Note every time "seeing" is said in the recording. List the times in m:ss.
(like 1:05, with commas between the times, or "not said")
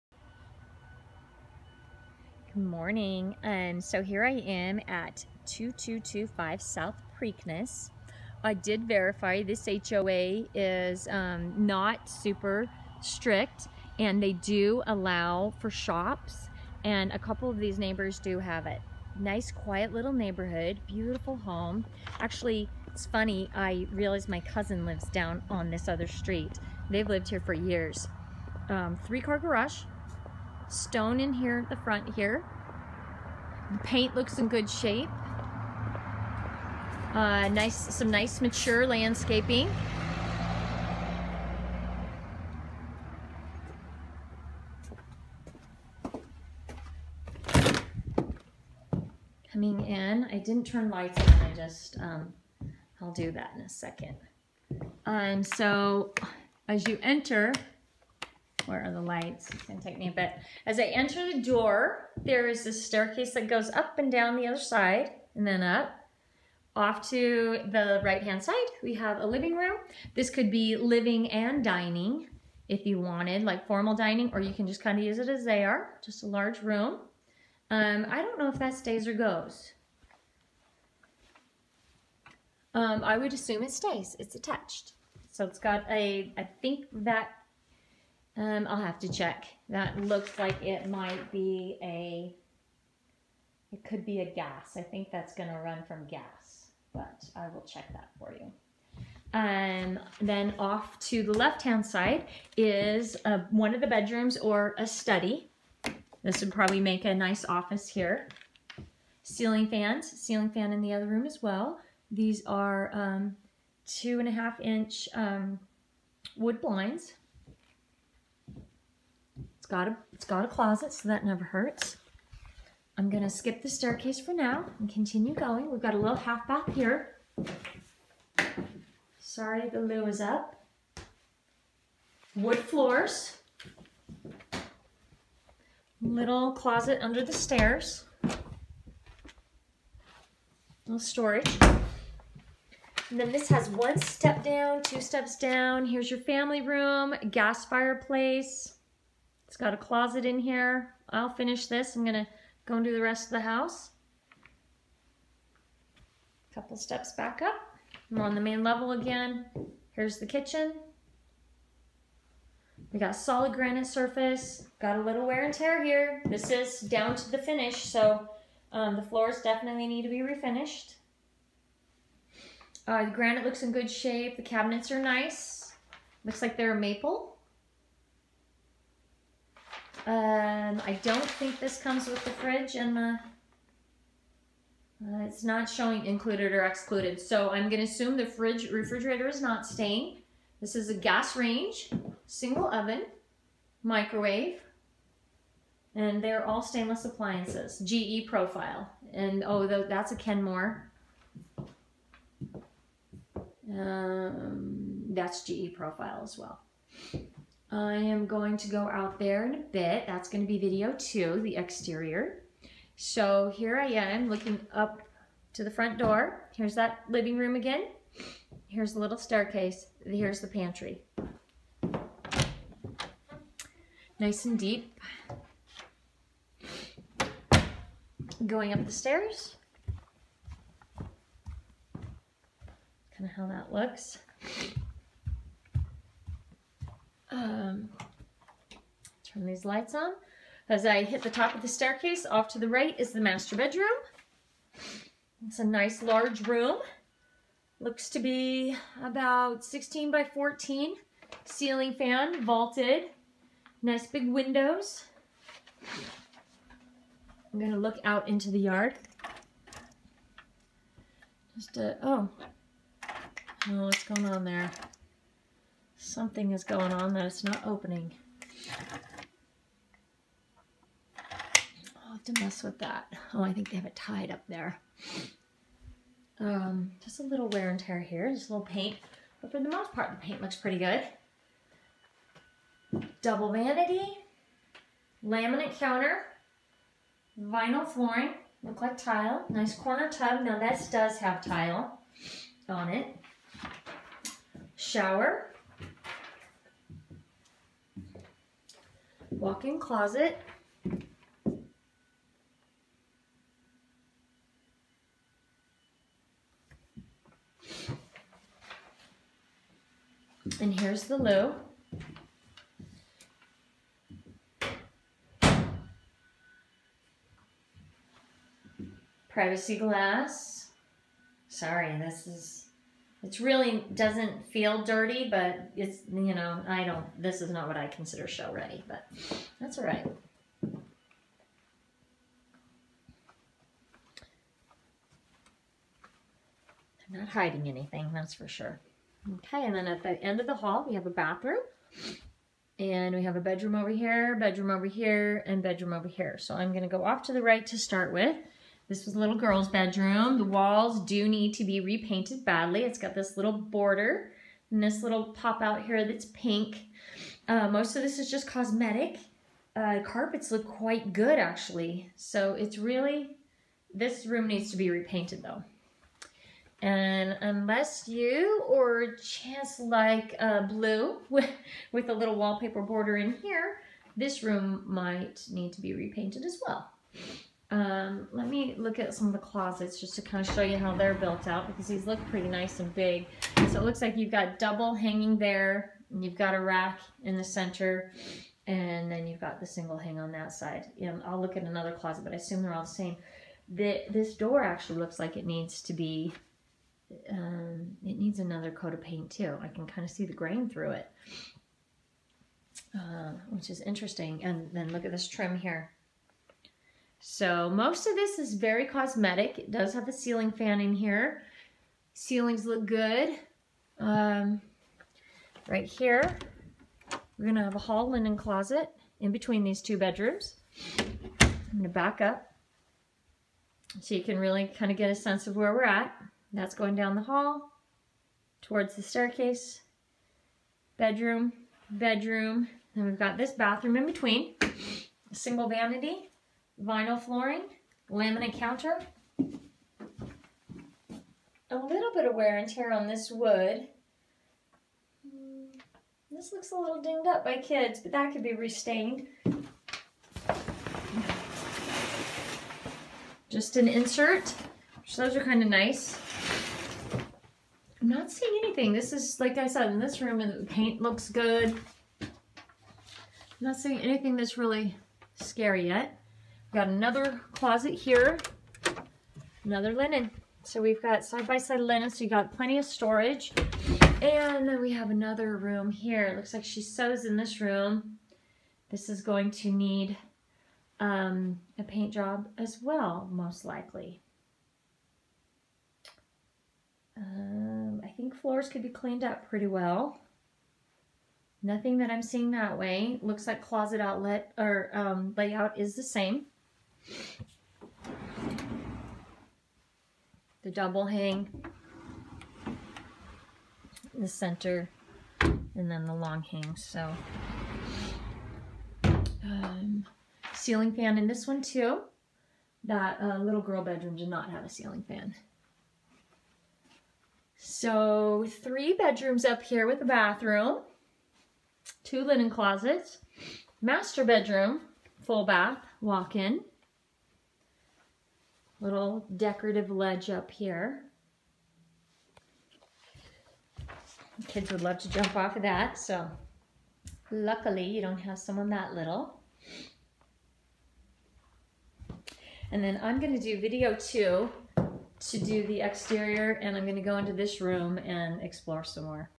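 7:38, 7:43, 8:12.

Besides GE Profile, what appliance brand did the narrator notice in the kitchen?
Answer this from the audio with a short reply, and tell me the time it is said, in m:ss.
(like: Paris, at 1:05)
Kenmore, at 3:20.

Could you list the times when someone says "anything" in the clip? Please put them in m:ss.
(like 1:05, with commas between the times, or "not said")
5:37, 7:38, 7:43.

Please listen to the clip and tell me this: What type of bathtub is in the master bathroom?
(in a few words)
corner tub.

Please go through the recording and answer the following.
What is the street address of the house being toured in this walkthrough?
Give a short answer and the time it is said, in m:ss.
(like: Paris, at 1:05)
2225 South Preakness, at 0:05.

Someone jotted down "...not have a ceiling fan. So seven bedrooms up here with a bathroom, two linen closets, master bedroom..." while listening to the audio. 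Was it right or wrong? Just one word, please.
wrong.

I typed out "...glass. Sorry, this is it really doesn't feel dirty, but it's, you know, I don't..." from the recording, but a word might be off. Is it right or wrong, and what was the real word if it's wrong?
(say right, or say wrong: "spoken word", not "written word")
right.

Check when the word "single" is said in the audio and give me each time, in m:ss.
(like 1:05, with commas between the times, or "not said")
3:12, 6:29, 7:15.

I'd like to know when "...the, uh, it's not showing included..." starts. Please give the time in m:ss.
3:02.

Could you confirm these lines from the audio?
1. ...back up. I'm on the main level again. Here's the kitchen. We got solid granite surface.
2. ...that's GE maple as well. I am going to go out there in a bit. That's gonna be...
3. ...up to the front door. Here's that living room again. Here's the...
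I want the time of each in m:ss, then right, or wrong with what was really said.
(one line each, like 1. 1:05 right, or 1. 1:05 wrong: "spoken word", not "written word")
1. 2:37 right
2. 3:25 wrong: "profile", not "maple"
3. 3:34 right.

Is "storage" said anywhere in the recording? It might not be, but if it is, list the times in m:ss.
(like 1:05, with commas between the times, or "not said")
2:20, 7:52.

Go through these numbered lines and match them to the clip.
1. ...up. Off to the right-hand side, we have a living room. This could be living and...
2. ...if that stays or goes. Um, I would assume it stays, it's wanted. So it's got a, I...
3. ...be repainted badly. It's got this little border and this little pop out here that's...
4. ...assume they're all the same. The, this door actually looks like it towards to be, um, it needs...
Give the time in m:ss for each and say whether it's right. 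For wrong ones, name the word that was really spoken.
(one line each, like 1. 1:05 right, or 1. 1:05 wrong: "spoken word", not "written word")
1. 1:05 right
2. 1:18 wrong: "attached", not "wanted"
3. 5:51 right
4. 6:32 wrong: "needs", not "towards".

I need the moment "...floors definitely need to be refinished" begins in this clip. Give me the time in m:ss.
2:49.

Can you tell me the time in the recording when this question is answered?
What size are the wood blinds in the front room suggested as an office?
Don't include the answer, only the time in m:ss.
1:53.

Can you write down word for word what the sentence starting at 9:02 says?
And then I'm gonna do video two to do the exterior and I'm gonna go into this room and explore some more.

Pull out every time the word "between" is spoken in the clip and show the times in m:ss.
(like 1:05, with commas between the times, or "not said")
6:59, 7:14.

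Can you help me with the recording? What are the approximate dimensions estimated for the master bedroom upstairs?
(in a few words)
16 by 14.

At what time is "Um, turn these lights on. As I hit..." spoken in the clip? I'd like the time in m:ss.
3:57.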